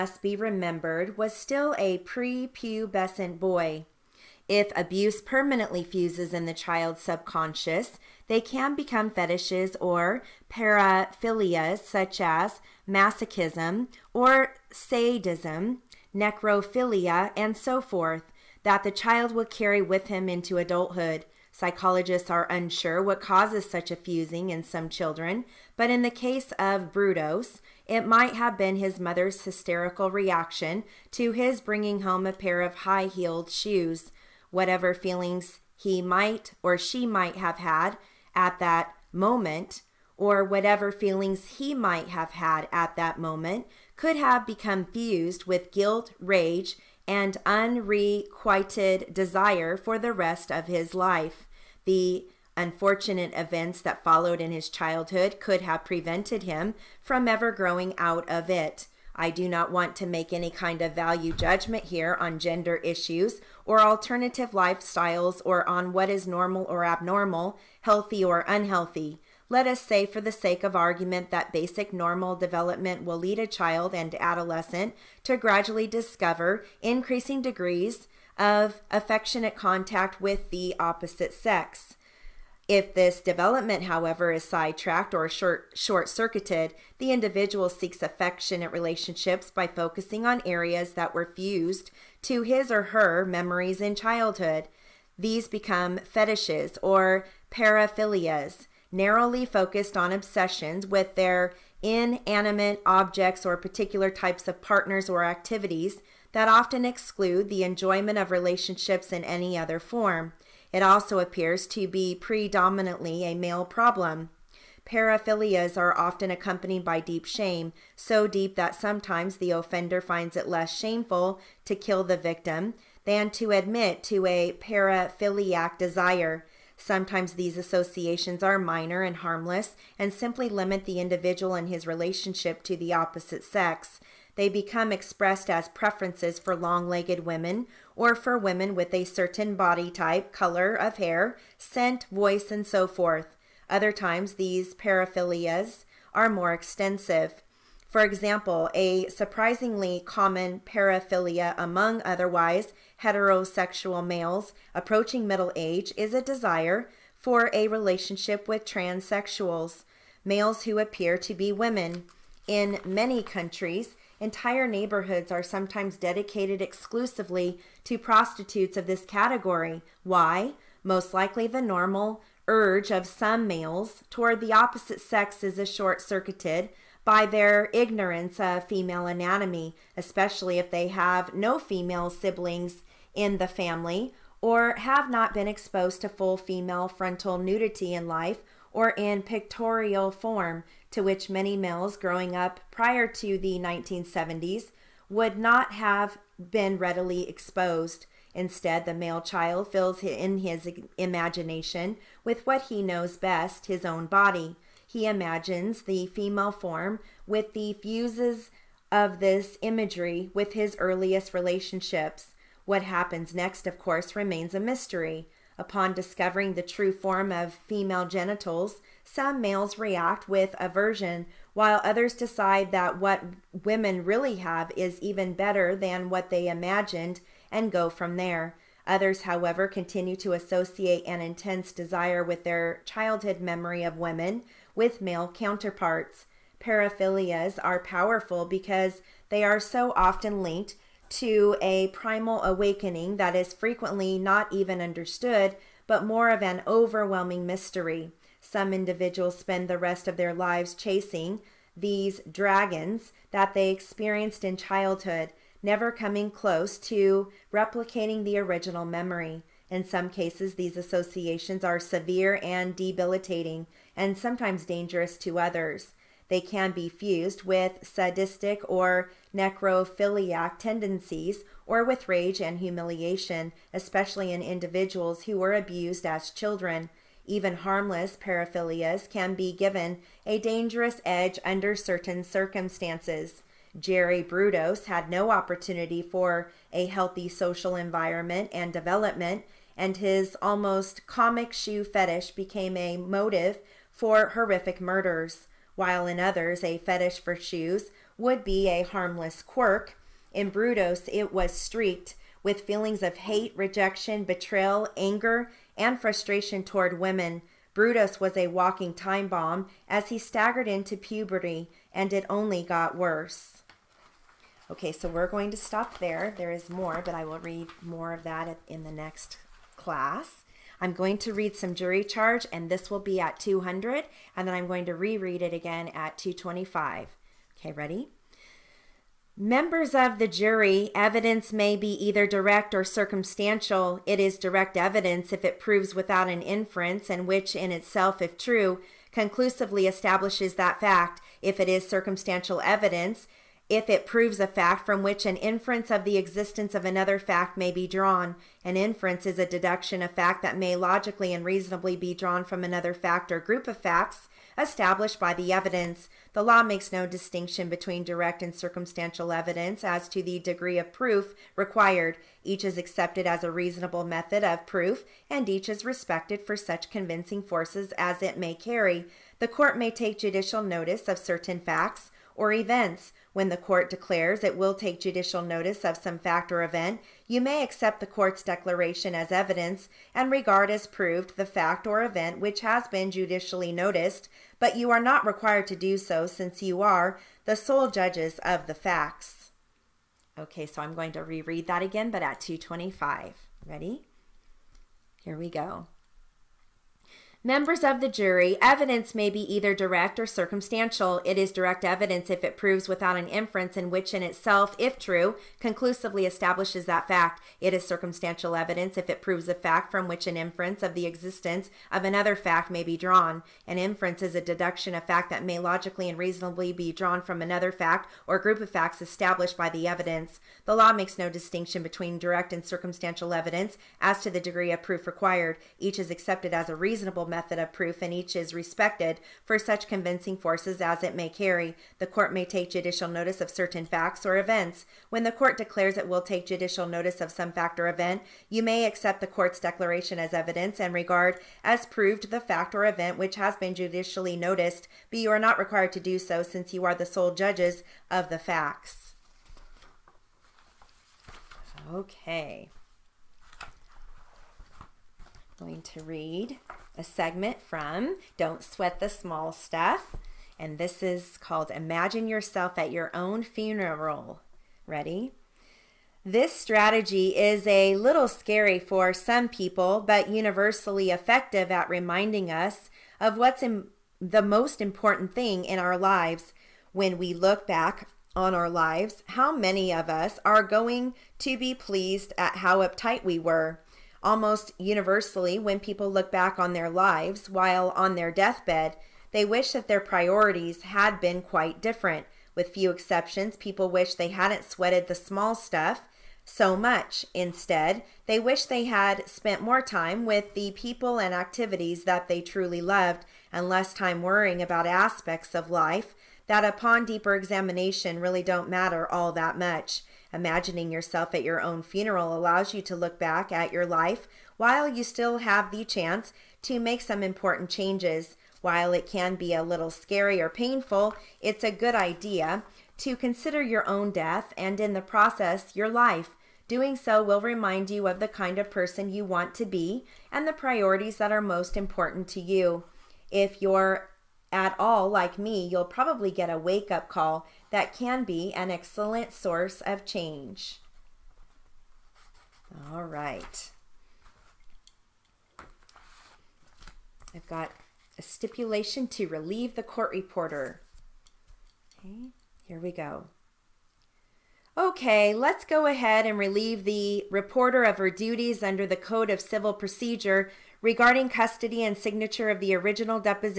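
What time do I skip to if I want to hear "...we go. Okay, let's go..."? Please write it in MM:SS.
09:12.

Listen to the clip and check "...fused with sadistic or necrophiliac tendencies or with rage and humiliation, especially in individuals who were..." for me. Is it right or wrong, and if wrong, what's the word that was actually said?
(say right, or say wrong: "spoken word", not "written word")
right.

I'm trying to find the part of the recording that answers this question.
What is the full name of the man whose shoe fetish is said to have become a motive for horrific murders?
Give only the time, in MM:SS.
04:43.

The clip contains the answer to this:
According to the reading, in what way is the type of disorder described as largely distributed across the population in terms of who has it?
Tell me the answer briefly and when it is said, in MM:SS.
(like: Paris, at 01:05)
predominantly a male problem, at 01:52.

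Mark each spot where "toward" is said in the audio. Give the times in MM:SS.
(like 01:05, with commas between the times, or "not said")
02:54, 05:06.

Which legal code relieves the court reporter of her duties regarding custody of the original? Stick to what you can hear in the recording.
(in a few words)
Code of Civil Procedure.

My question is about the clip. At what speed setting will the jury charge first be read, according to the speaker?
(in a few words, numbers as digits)
200.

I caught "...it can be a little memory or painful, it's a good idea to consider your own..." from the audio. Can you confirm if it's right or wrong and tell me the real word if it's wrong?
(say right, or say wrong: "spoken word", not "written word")
wrong: "scary", not "memory".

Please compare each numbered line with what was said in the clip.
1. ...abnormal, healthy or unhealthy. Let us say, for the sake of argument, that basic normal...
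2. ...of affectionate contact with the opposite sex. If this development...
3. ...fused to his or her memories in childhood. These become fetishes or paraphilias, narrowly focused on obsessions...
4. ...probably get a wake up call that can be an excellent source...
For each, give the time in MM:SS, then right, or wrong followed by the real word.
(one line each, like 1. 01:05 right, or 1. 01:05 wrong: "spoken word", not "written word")
1. 01:06 right
2. 01:18 right
3. 01:31 right
4. 08:55 right.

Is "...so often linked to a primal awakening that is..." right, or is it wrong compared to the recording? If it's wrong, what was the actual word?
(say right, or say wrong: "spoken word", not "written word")
right.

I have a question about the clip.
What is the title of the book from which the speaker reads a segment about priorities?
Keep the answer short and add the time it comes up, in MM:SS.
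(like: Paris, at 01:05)
Don't Sweat the Small Stuff, at 07:38.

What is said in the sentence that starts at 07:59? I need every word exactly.
How many of us are going to be pleased at how uptight we were?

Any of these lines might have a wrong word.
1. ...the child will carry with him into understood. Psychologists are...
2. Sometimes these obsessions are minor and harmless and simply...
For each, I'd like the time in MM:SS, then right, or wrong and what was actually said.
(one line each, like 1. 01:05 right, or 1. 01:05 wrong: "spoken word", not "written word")
1. 00:18 wrong: "adulthood", not "understood"
2. 02:06 wrong: "associations", not "obsessions".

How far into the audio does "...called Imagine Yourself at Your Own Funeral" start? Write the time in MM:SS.
07:41.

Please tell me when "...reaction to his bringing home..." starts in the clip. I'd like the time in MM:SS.
00:30.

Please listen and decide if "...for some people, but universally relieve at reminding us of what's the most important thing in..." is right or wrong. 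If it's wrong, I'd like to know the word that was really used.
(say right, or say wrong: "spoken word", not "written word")
wrong: "effective", not "relieve".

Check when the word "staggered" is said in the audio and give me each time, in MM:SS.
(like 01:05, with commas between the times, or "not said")
05:10.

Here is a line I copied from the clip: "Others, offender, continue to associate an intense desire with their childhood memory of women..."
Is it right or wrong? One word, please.
wrong.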